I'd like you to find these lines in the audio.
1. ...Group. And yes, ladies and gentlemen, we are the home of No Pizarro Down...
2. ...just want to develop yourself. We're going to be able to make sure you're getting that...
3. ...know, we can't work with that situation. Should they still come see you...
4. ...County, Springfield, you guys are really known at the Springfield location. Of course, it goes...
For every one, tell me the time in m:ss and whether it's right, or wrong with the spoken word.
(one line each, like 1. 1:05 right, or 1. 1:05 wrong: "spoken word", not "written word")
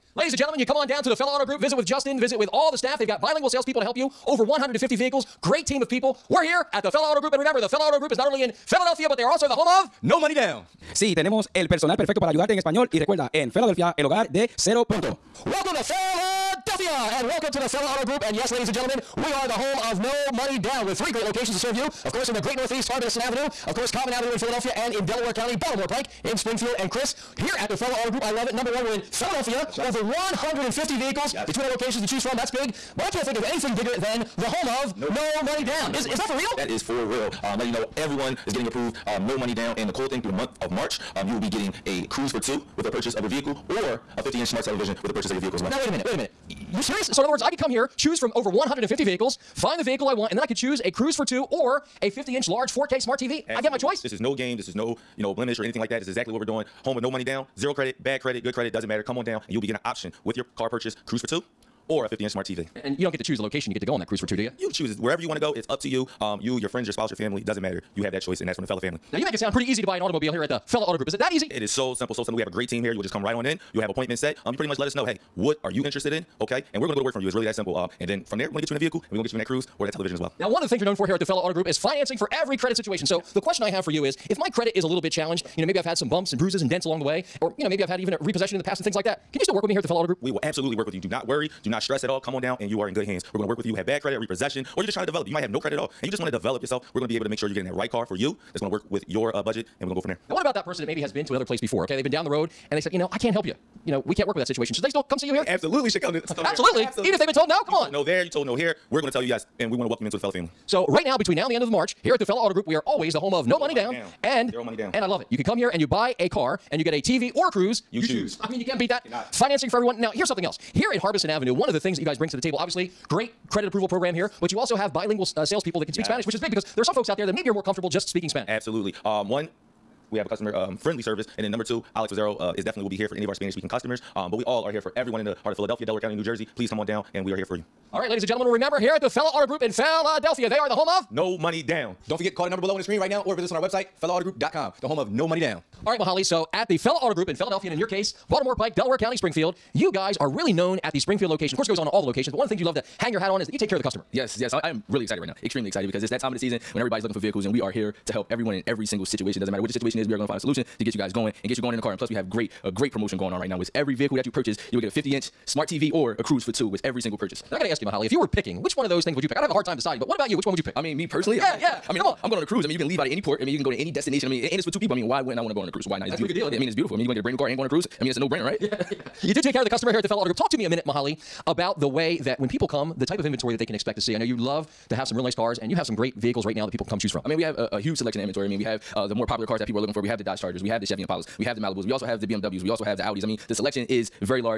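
1. 0:18 wrong: "Money", not "Pizarro"
2. 1:36 right
3. 1:43 right
4. 2:28 right.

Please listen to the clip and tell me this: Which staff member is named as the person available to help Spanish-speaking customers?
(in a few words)
Alex Pizarro.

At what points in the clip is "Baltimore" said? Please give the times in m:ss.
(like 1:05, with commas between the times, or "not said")
0:25, 2:28.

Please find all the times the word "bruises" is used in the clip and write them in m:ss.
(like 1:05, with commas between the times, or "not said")
1:26.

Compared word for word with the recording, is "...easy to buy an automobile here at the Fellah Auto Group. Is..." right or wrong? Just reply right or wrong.
right.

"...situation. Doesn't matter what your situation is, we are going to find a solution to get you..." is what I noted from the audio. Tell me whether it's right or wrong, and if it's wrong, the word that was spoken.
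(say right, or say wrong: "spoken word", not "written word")
right.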